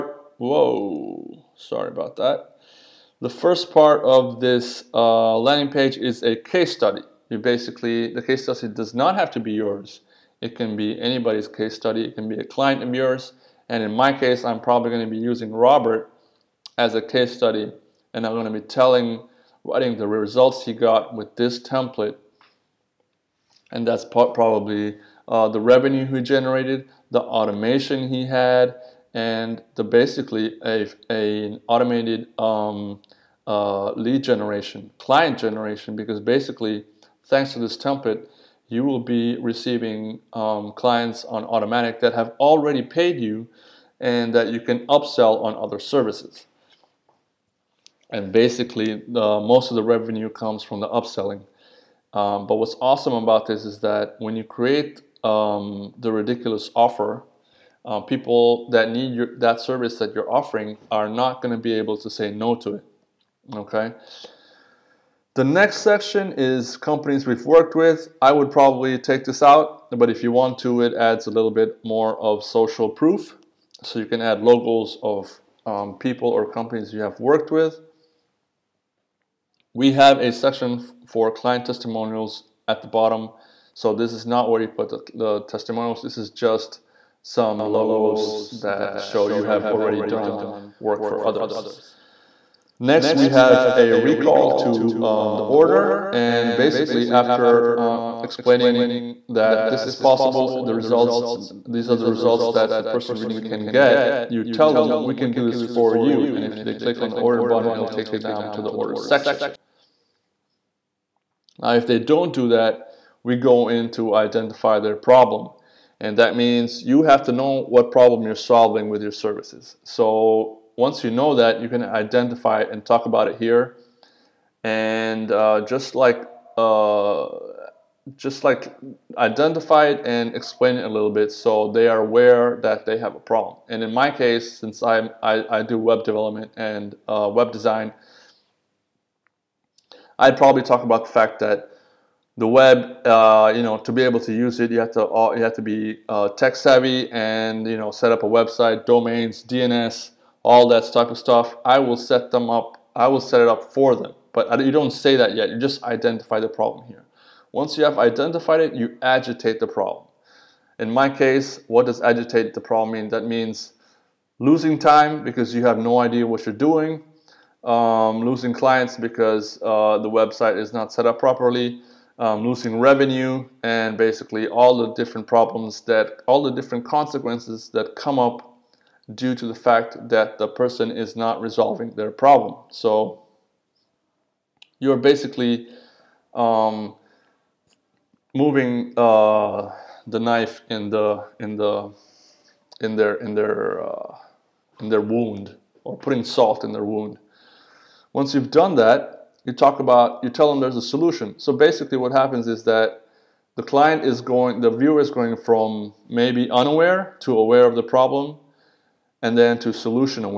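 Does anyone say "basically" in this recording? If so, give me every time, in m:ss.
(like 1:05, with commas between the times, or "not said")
0:07, 0:29, 0:36, 0:48, 1:36, 2:53, 3:04, 3:21.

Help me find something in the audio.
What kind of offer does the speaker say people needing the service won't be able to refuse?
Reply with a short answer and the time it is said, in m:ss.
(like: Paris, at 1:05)
Ridiculous offer, at 0:56.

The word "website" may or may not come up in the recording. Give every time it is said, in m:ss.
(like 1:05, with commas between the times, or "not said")
2:28, 2:50.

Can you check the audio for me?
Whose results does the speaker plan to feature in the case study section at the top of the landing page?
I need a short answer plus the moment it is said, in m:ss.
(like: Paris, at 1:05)
Robert, at 0:15.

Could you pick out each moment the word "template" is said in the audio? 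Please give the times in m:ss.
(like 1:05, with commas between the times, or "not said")
0:21, 0:37.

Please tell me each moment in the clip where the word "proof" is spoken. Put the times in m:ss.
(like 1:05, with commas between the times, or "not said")
1:12.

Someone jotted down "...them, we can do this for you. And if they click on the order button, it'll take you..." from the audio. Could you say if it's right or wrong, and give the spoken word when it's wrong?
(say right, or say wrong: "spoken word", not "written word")
right.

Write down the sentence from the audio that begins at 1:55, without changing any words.
And that means you have to know what problem you're solving with your services.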